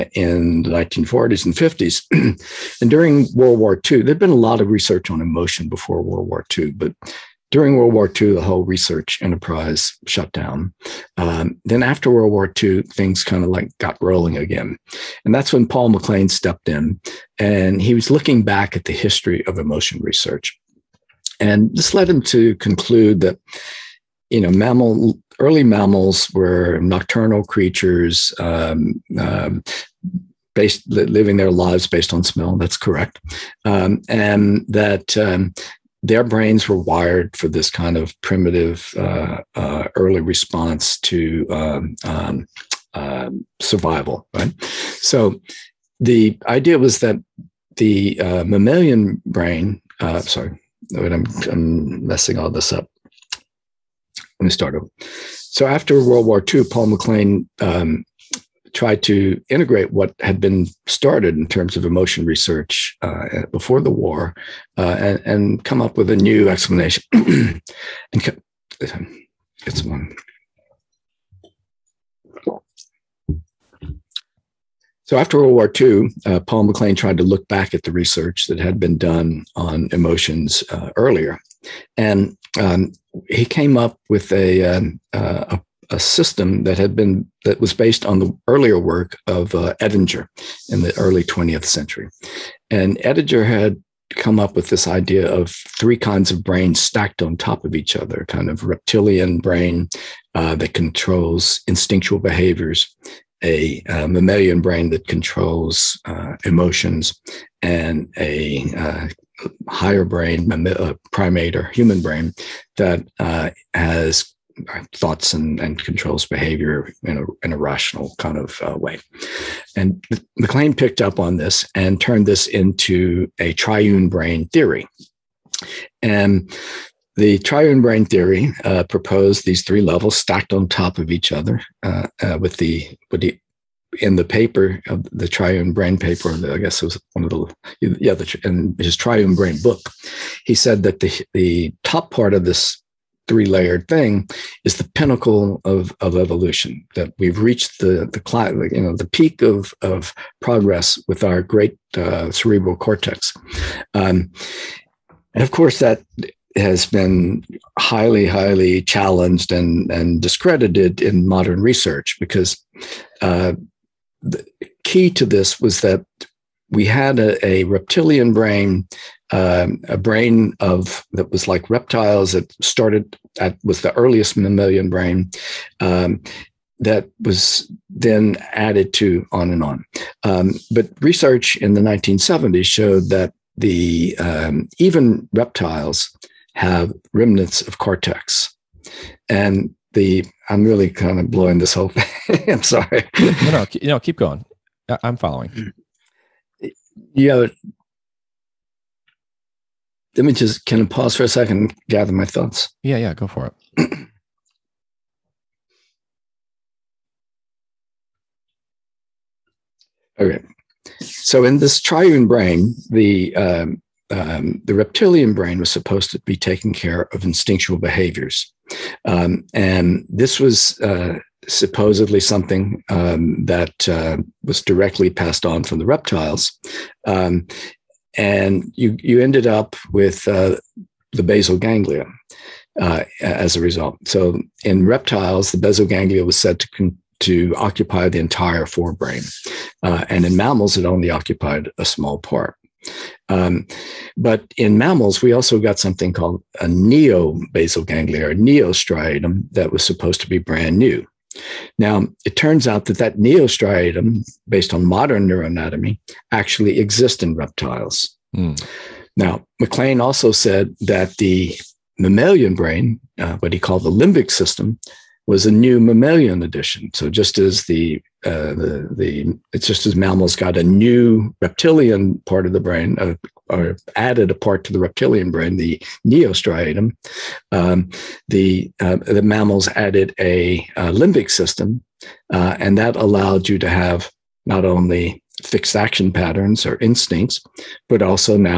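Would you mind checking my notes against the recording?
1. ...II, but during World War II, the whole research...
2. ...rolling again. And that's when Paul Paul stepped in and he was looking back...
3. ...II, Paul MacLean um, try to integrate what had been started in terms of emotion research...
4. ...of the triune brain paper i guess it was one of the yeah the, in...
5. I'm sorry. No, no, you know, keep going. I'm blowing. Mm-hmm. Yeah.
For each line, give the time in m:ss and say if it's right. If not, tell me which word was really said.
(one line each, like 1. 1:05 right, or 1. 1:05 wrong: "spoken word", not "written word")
1. 0:06 right
2. 0:14 wrong: "MacLean", not "Paul"
3. 0:56 right
4. 2:14 right
5. 3:12 wrong: "following", not "blowing".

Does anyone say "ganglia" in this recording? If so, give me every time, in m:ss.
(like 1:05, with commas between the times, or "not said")
3:51, 3:55, 4:07.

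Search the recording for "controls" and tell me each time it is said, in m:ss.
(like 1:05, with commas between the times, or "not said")
1:40, 1:45, 1:55.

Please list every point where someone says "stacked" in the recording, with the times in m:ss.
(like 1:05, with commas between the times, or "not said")
1:36, 2:10.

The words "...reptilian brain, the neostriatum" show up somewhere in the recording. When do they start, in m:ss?
4:34.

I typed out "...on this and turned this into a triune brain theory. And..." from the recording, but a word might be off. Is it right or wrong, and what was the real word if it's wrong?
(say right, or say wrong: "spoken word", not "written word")
right.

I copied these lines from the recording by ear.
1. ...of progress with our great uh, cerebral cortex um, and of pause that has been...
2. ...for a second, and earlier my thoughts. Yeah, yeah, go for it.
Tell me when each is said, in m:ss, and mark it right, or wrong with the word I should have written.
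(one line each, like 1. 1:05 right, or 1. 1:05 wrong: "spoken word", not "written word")
1. 2:29 wrong: "course", not "pause"
2. 3:21 wrong: "gather", not "earlier".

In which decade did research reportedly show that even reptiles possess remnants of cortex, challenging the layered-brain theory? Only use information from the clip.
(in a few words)
1970s.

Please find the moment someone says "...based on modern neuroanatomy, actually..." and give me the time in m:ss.
4:14.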